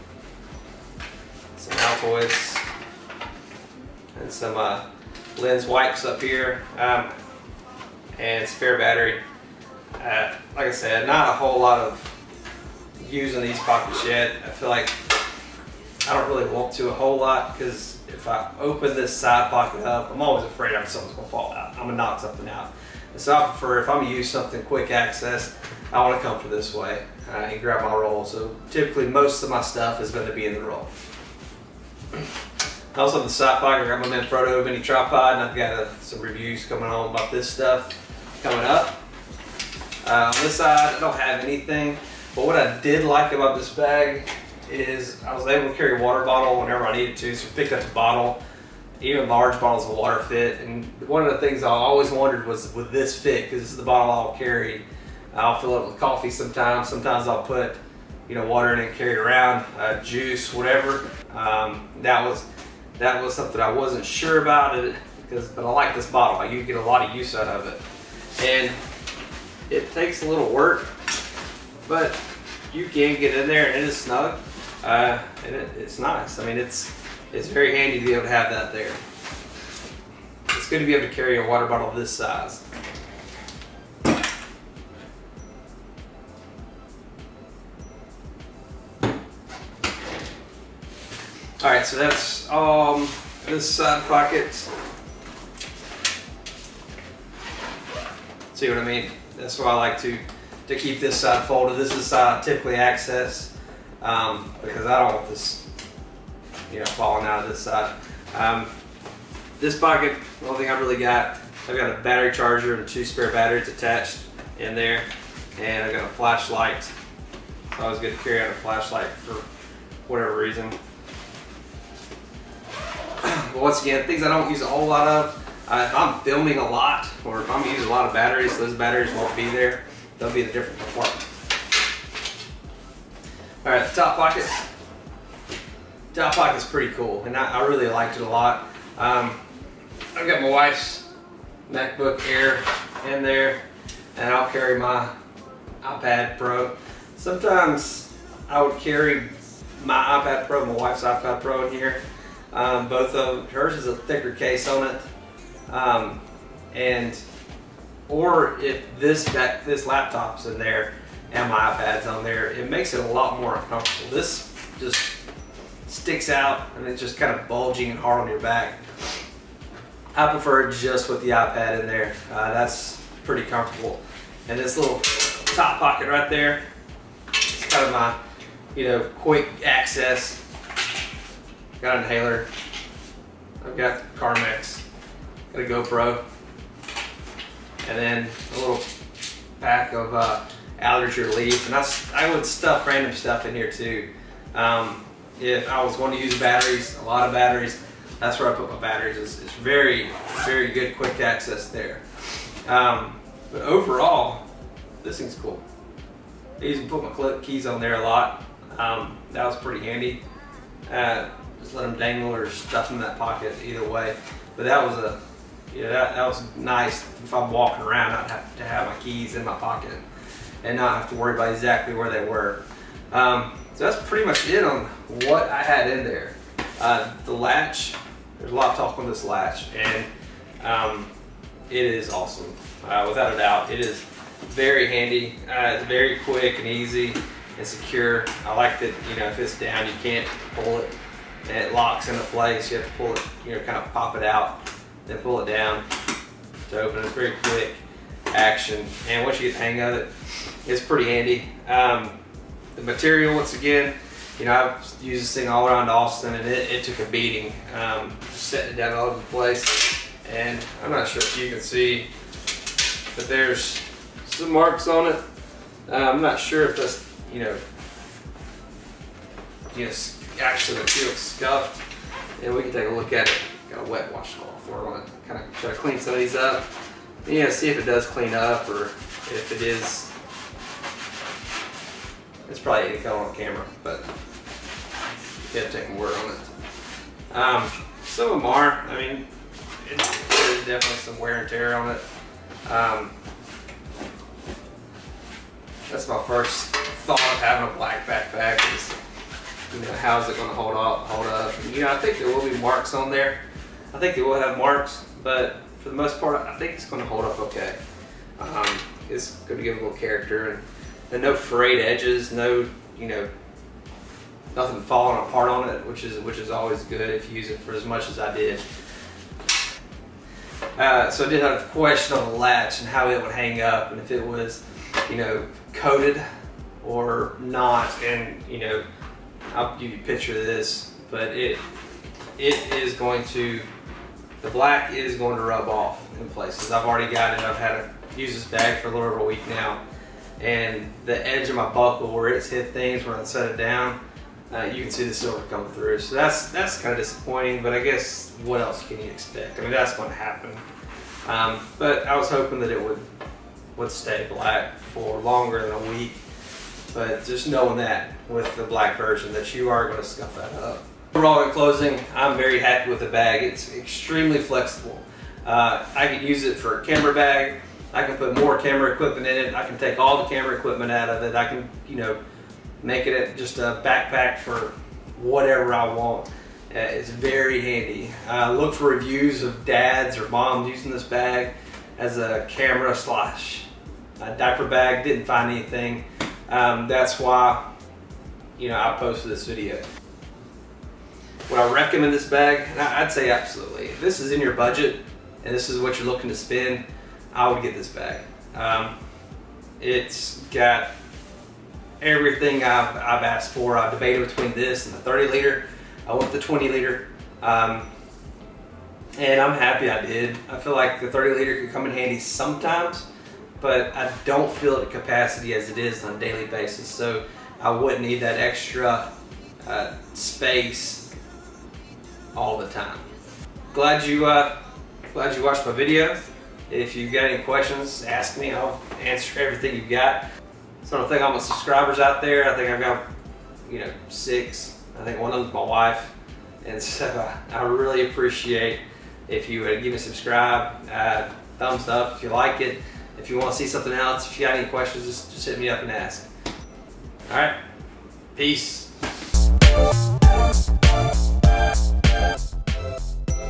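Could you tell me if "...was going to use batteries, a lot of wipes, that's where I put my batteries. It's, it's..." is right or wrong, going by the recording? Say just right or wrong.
wrong.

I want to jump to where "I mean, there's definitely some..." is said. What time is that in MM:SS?
04:48.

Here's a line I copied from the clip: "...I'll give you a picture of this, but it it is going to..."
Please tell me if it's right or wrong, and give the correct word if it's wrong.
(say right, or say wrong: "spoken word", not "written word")
right.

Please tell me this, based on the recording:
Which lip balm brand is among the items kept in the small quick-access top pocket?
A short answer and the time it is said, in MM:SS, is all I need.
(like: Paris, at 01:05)
Carmex, at 03:04.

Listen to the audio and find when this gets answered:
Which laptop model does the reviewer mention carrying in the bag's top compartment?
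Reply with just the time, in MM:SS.
02:21.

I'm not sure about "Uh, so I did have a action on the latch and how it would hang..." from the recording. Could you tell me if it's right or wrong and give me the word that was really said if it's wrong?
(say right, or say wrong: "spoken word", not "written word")
wrong: "question", not "action".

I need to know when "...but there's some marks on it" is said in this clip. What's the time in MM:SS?
04:23.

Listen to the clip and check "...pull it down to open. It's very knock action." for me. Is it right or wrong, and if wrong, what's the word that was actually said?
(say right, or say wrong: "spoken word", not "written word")
wrong: "quick", not "knock".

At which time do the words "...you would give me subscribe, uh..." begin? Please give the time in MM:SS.
07:19.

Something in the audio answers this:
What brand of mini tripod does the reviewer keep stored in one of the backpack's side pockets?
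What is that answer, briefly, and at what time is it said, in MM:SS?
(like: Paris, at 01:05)
Manfrotto, at 00:34.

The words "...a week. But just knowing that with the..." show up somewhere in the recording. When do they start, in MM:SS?
05:55.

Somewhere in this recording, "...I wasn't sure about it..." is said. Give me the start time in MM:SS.
01:03.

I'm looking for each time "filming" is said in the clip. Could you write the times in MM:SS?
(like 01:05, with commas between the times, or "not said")
02:06.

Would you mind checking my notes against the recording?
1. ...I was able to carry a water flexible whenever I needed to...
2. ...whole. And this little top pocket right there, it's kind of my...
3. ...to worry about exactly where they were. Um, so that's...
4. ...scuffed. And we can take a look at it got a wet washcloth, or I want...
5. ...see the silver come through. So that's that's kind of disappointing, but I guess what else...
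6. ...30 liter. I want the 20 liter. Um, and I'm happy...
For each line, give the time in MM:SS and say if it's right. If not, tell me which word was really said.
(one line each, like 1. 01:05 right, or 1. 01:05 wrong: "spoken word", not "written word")
1. 00:45 wrong: "bottle", not "flexible"
2. 02:53 wrong: "comfortable", not "whole"
3. 03:41 right
4. 04:31 right
5. 05:44 right
6. 06:44 right.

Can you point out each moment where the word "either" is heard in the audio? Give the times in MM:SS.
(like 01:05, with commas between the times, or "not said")
03:33.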